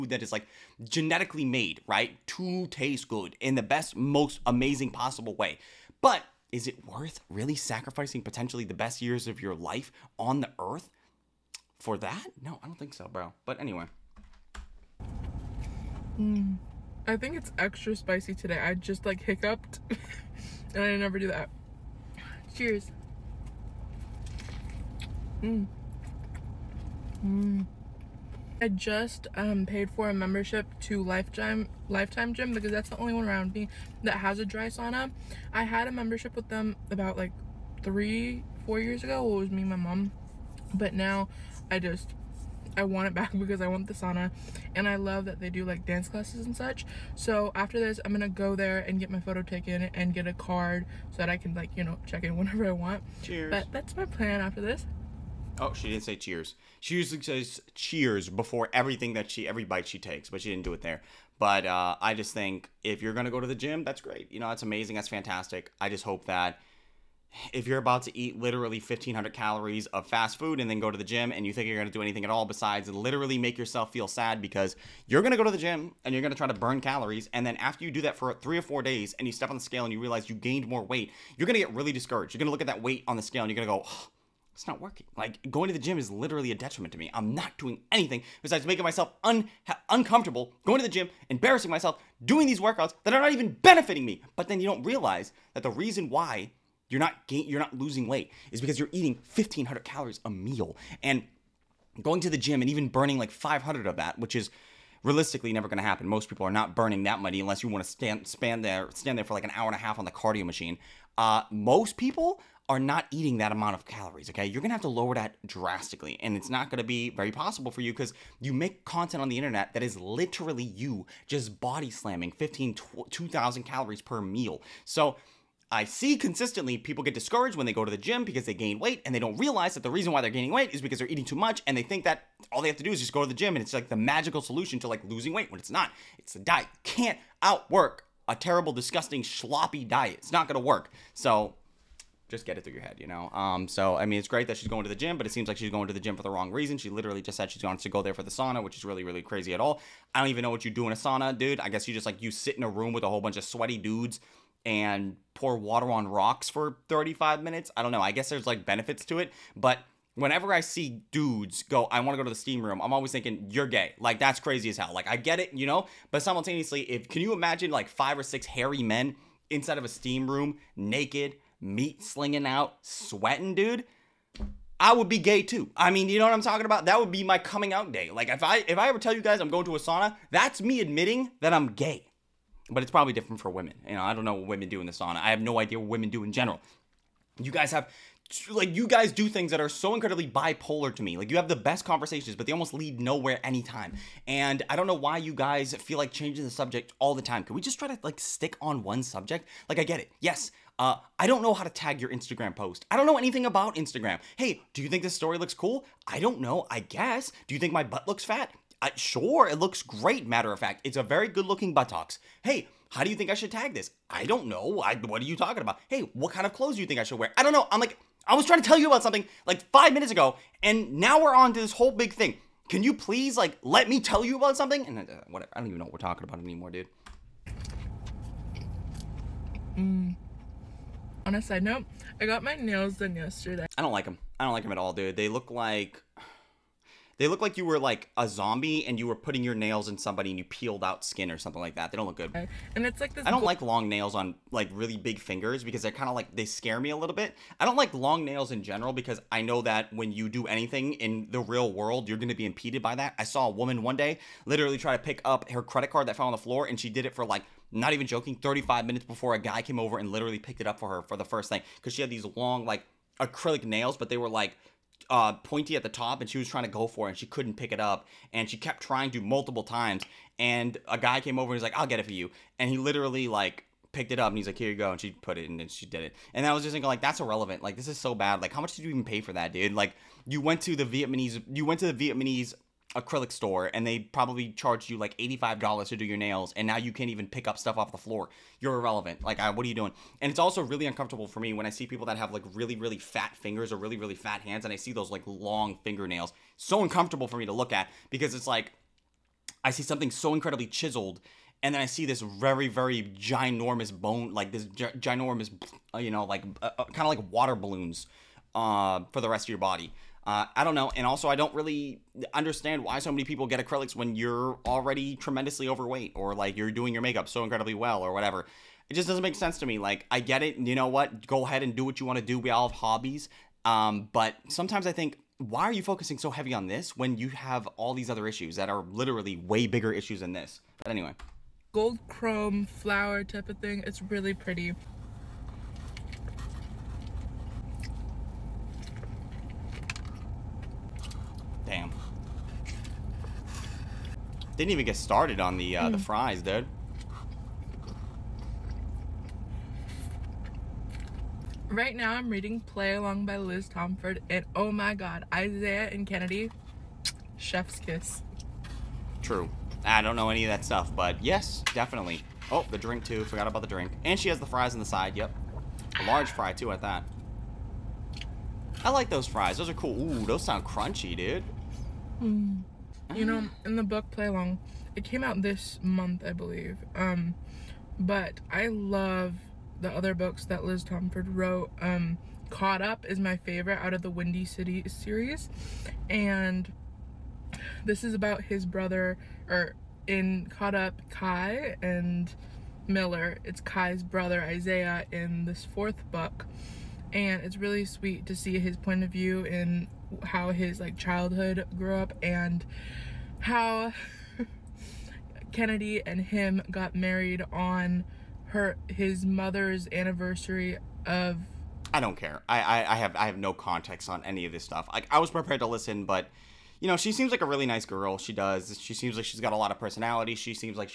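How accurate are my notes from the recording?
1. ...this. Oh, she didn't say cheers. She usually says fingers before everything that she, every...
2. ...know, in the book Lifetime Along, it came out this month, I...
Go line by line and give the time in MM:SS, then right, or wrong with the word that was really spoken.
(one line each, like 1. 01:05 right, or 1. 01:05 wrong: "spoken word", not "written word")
1. 00:54 wrong: "cheers", not "fingers"
2. 06:13 wrong: "Play", not "Lifetime".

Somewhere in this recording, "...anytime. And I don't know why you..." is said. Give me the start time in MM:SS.
03:13.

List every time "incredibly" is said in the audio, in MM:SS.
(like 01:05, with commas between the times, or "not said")
03:09, 05:00, 05:17.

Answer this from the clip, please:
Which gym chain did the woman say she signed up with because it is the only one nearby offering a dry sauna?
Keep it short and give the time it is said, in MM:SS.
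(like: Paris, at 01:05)
Lifetime, at 00:31.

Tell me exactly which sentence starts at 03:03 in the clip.
You know, I don't know what women do in the sauna.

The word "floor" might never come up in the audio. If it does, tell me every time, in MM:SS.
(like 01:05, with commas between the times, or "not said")
04:16, 04:47.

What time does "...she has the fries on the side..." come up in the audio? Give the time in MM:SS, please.
06:04.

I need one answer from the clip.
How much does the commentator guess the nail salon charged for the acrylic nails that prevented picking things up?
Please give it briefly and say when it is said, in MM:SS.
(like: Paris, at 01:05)
$85, at 04:45.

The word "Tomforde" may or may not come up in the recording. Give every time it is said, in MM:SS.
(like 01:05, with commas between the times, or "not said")
05:53, 06:20.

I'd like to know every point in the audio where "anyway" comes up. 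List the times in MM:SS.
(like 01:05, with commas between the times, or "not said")
00:13, 05:30.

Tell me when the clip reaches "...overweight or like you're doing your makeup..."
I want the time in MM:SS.
05:15.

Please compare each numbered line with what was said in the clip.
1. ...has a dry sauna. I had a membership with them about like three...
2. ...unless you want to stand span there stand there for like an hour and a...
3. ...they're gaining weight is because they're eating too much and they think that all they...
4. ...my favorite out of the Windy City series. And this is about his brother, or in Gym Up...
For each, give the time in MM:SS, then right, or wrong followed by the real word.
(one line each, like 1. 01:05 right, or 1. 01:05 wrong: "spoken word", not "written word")
1. 00:34 right
2. 01:47 right
3. 02:10 right
4. 06:23 wrong: "Caught", not "Gym".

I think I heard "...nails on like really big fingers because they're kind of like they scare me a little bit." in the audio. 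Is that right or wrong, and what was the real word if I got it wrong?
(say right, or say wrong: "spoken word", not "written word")
right.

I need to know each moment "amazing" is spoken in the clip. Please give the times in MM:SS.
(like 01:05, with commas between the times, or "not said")
00:04, 01:04.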